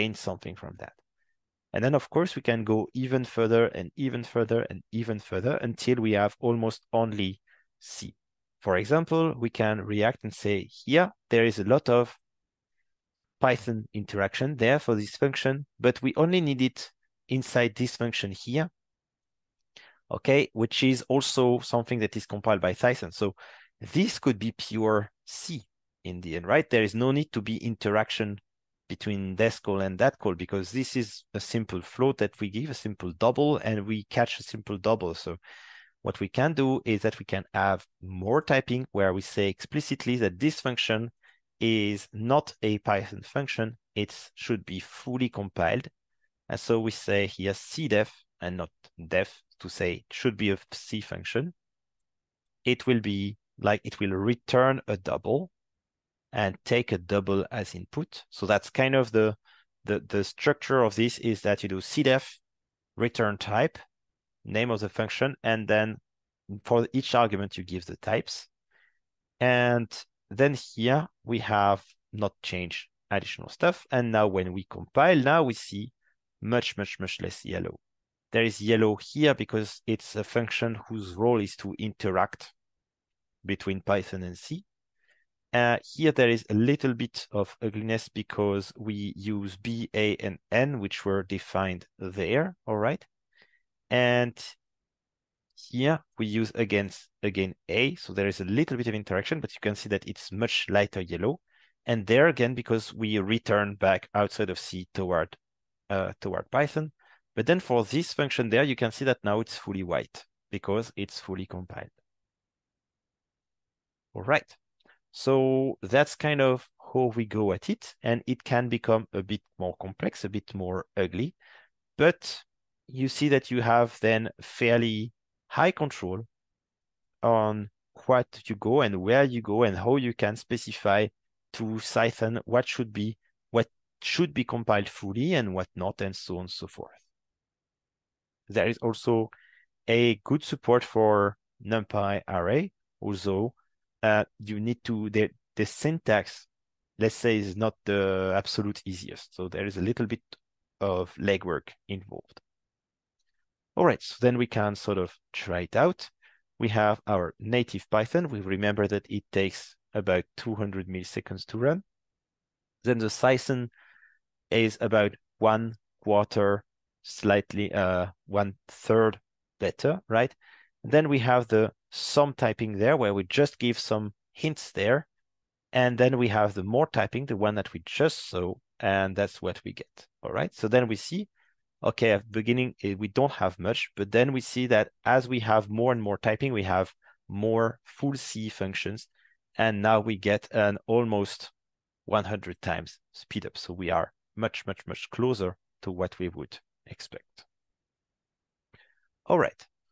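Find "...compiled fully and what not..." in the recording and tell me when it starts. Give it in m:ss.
2:14.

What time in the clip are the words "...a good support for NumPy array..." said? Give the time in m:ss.
2:19.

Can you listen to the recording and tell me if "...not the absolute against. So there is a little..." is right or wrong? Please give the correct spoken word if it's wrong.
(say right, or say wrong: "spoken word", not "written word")
wrong: "easiest", not "against".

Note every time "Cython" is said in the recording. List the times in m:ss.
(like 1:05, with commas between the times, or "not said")
0:22, 1:46, 2:43.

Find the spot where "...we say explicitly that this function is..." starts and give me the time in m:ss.
0:39.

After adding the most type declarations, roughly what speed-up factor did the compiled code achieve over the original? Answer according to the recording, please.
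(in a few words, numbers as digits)
100 times.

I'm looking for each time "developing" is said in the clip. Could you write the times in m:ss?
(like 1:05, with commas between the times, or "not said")
not said.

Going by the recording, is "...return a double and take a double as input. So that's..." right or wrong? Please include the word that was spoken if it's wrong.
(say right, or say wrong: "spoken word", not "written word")
right.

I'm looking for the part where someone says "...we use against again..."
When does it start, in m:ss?
1:36.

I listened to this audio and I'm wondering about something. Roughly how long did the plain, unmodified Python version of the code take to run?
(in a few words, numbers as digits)
200 milliseconds.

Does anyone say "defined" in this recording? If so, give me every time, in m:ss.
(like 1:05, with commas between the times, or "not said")
1:31.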